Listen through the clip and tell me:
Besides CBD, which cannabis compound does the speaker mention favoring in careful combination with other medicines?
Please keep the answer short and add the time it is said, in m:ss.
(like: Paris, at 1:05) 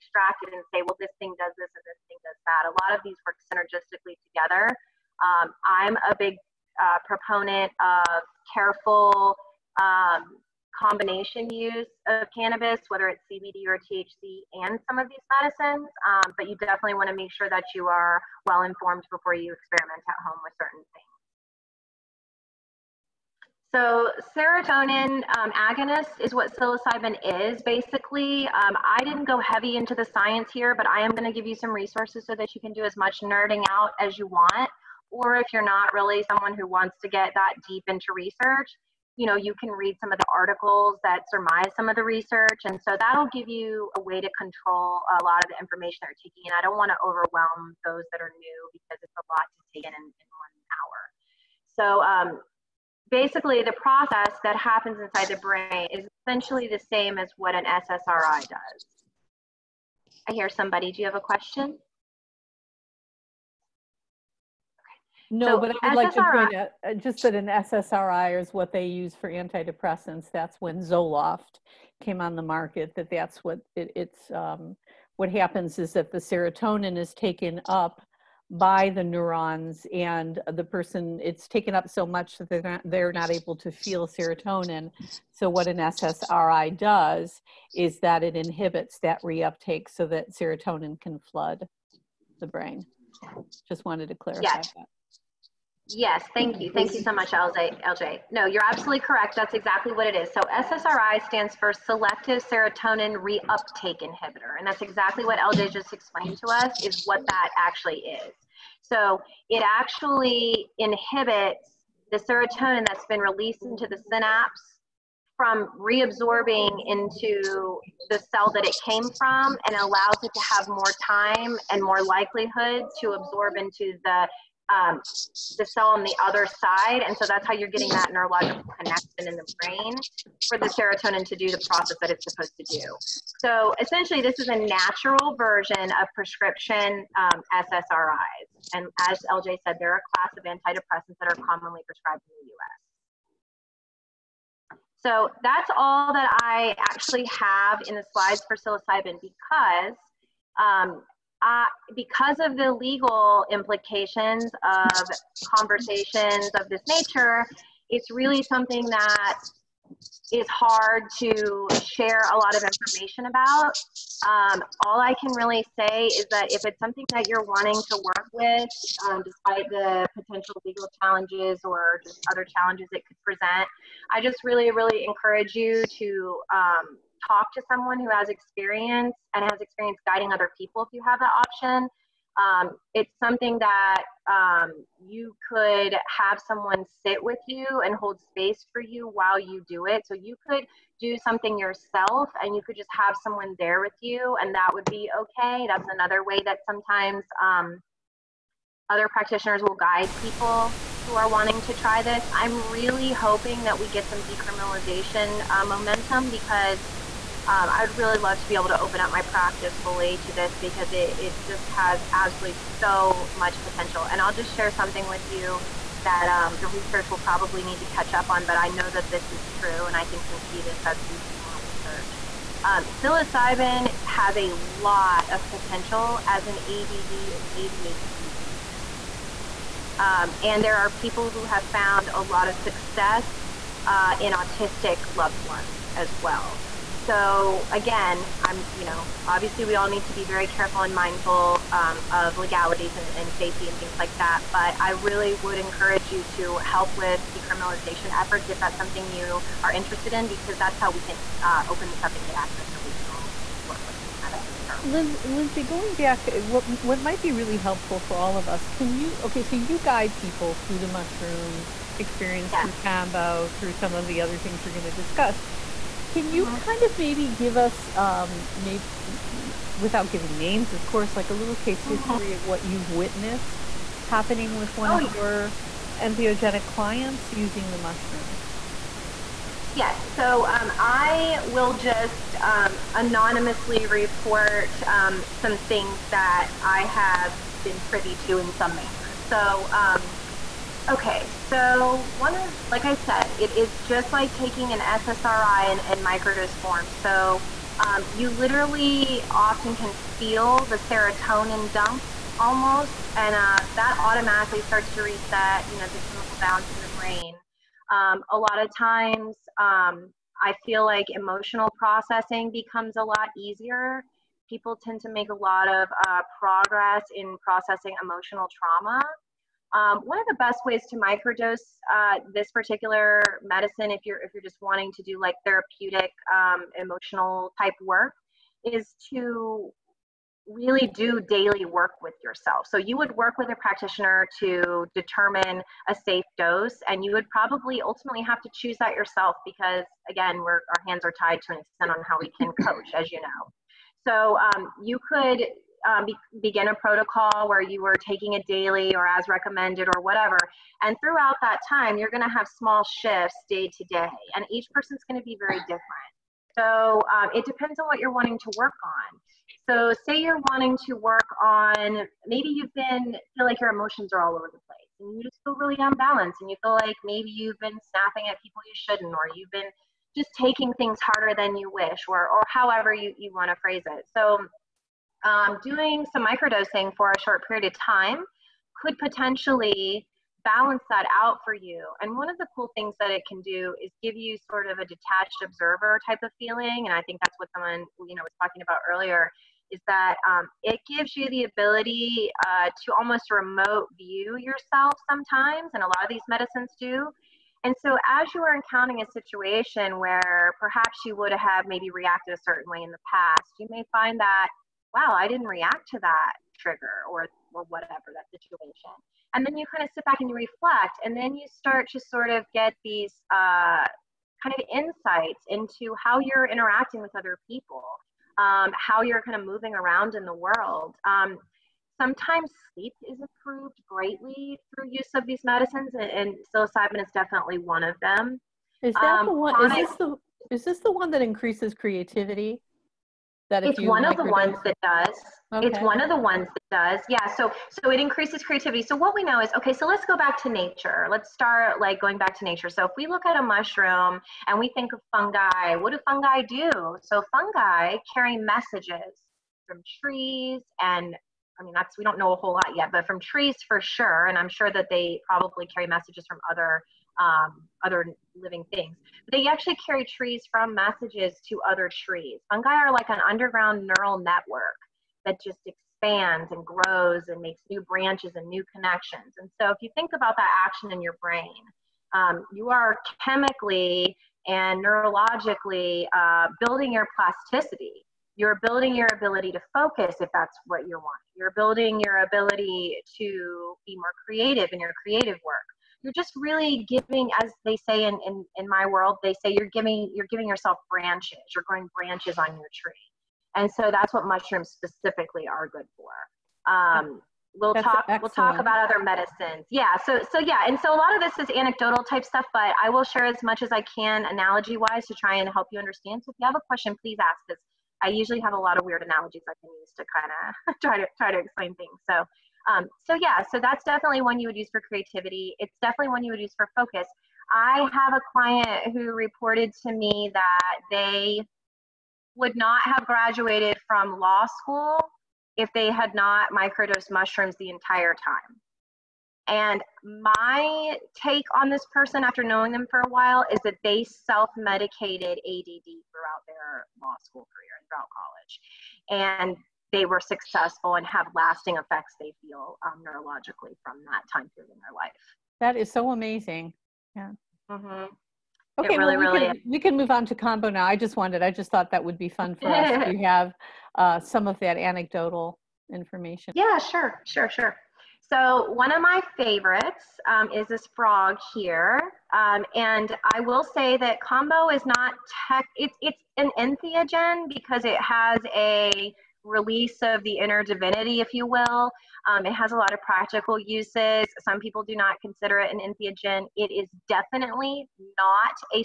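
THC, at 0:13.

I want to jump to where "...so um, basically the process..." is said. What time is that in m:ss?
0:51.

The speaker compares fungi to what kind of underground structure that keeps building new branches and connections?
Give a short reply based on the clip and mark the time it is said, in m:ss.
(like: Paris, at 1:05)
neural network, at 7:43.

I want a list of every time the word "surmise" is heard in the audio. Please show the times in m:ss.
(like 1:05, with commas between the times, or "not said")
0:41.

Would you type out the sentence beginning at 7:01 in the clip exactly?
Um, sometimes sleep is improved greatly through use of these medicines, and, and psilocybin is definitely one of them.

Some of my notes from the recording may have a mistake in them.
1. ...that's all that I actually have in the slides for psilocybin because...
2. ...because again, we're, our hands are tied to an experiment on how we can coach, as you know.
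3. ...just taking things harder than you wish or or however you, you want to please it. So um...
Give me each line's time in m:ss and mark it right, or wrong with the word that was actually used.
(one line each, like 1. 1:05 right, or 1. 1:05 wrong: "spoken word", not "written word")
1. 2:25 right
2. 5:39 wrong: "extent", not "experiment"
3. 6:10 wrong: "phrase", not "please".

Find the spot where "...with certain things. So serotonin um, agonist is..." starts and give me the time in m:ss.
0:20.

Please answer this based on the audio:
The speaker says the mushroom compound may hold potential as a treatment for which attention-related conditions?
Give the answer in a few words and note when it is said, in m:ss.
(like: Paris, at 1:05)
ADD and ADHD, at 3:46.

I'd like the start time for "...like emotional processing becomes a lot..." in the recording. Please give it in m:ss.
5:10.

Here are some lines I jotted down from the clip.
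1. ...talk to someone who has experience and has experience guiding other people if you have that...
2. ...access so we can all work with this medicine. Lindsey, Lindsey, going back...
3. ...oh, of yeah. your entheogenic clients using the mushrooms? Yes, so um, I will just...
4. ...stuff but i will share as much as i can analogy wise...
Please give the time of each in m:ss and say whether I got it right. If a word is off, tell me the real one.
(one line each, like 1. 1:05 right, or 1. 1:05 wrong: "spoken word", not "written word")
1. 2:57 right
2. 4:12 right
3. 4:34 right
4. 8:22 right.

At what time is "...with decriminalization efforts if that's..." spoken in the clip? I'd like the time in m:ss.
4:06.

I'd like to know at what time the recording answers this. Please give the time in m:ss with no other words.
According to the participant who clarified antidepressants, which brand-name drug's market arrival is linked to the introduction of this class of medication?
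1:10.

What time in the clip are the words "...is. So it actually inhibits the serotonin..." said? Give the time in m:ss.
1:47.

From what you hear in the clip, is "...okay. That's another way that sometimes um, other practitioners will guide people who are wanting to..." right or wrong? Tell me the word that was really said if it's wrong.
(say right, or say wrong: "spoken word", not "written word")
right.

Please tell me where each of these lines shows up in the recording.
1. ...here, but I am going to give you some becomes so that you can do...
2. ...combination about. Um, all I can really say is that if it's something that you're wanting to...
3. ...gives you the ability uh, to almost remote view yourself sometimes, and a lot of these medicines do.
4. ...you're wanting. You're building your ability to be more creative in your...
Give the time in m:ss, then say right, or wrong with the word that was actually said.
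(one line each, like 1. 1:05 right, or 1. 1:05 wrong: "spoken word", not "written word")
1. 0:30 wrong: "resources", not "becomes"
2. 2:42 wrong: "information", not "combination"
3. 6:30 right
4. 8:00 right.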